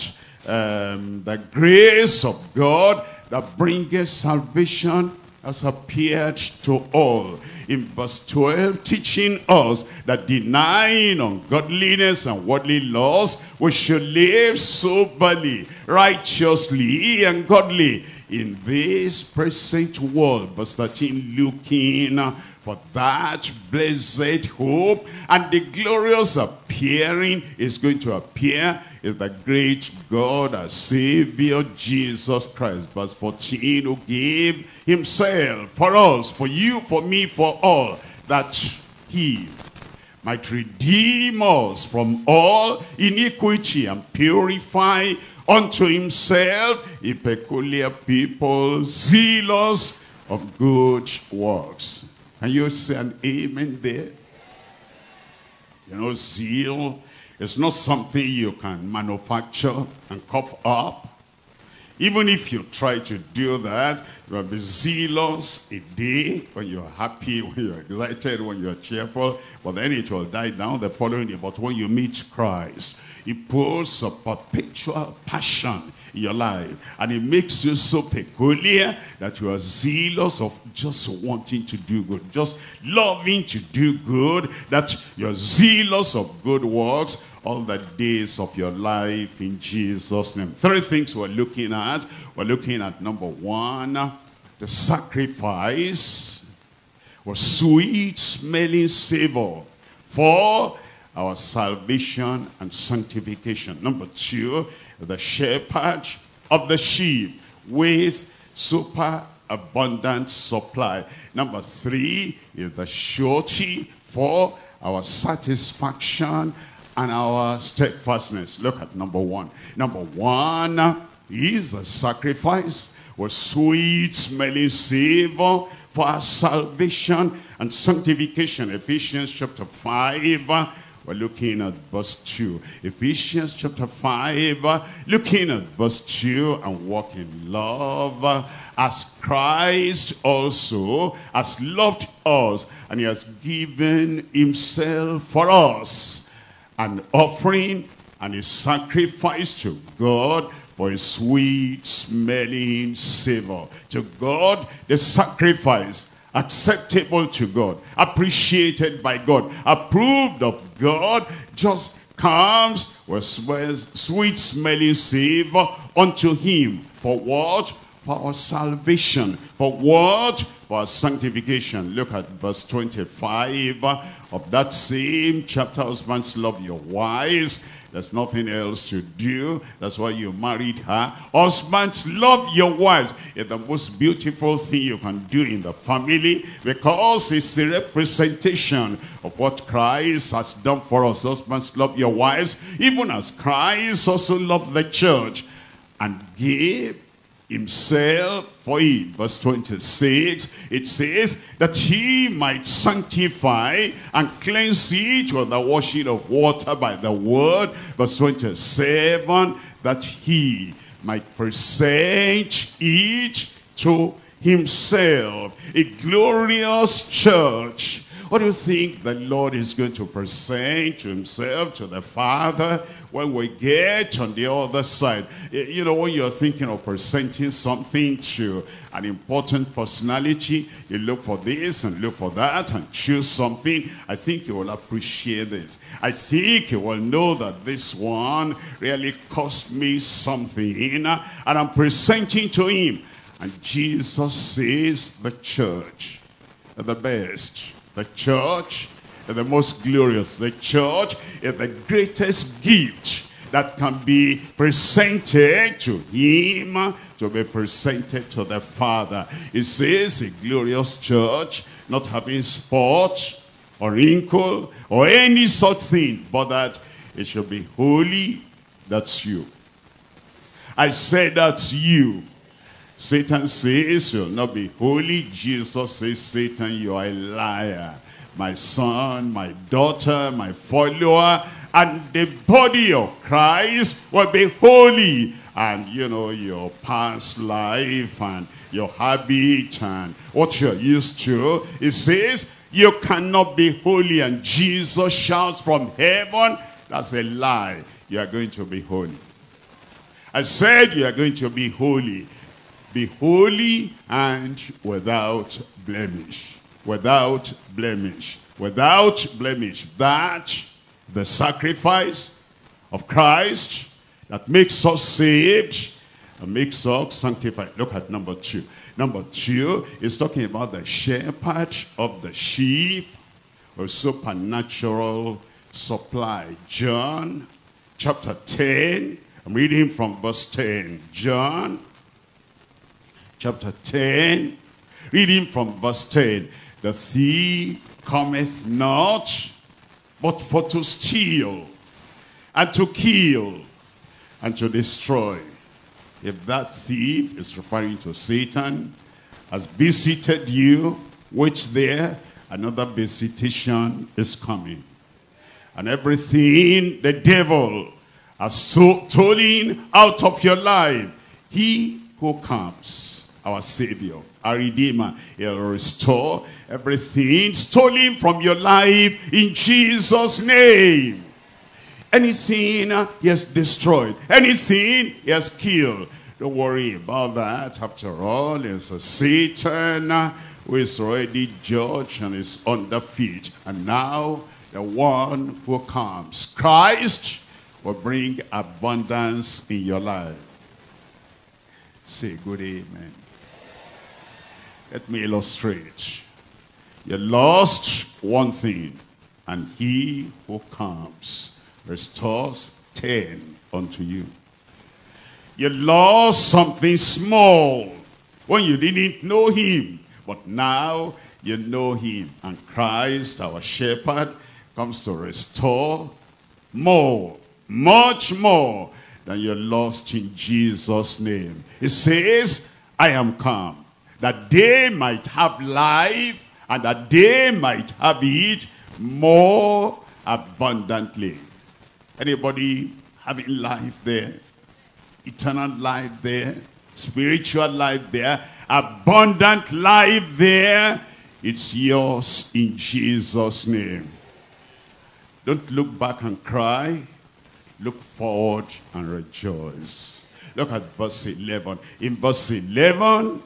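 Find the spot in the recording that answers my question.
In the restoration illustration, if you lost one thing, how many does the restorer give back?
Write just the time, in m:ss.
6:42.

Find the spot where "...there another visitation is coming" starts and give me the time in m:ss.
5:51.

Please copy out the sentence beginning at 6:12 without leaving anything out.
Anything uh, he has destroyed, anything he has killed.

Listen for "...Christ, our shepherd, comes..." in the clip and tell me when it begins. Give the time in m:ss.
6:52.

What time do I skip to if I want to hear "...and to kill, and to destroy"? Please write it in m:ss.
5:42.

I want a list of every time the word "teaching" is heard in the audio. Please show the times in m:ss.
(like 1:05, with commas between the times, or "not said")
0:08.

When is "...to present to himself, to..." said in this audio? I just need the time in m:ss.
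3:39.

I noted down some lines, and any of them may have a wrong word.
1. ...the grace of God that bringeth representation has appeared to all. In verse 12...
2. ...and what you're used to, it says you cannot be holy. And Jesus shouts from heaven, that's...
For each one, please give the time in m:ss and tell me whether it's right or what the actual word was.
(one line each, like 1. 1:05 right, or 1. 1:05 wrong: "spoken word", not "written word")
1. 0:01 wrong: "salvation", not "representation"
2. 4:49 right.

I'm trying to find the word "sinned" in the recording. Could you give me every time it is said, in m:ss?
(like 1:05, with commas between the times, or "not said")
not said.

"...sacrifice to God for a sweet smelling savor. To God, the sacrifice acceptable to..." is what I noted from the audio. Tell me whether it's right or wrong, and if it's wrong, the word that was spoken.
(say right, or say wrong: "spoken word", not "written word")
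right.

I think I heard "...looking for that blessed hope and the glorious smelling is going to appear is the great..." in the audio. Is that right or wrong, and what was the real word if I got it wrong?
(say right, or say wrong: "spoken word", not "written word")
wrong: "appearing", not "smelling".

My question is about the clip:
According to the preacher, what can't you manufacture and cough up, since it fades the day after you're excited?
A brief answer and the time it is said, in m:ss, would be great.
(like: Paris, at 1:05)
Zeal, at 0:56.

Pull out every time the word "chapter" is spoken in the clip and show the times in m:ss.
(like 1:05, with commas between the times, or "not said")
2:09, 2:13, 2:55, 5:27, 5:33.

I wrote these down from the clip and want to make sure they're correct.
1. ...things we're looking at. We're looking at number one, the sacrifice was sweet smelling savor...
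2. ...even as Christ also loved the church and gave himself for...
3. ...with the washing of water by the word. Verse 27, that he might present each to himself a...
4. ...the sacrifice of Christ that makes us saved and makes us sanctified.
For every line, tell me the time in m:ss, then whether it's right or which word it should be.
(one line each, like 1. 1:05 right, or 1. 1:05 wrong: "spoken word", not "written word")
1. 1:30 right
2. 3:12 right
3. 3:25 right
4. 5:11 right.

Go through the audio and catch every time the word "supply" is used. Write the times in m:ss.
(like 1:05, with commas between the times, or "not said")
1:50, 5:25.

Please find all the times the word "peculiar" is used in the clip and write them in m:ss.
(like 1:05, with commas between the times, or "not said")
0:47, 1:18.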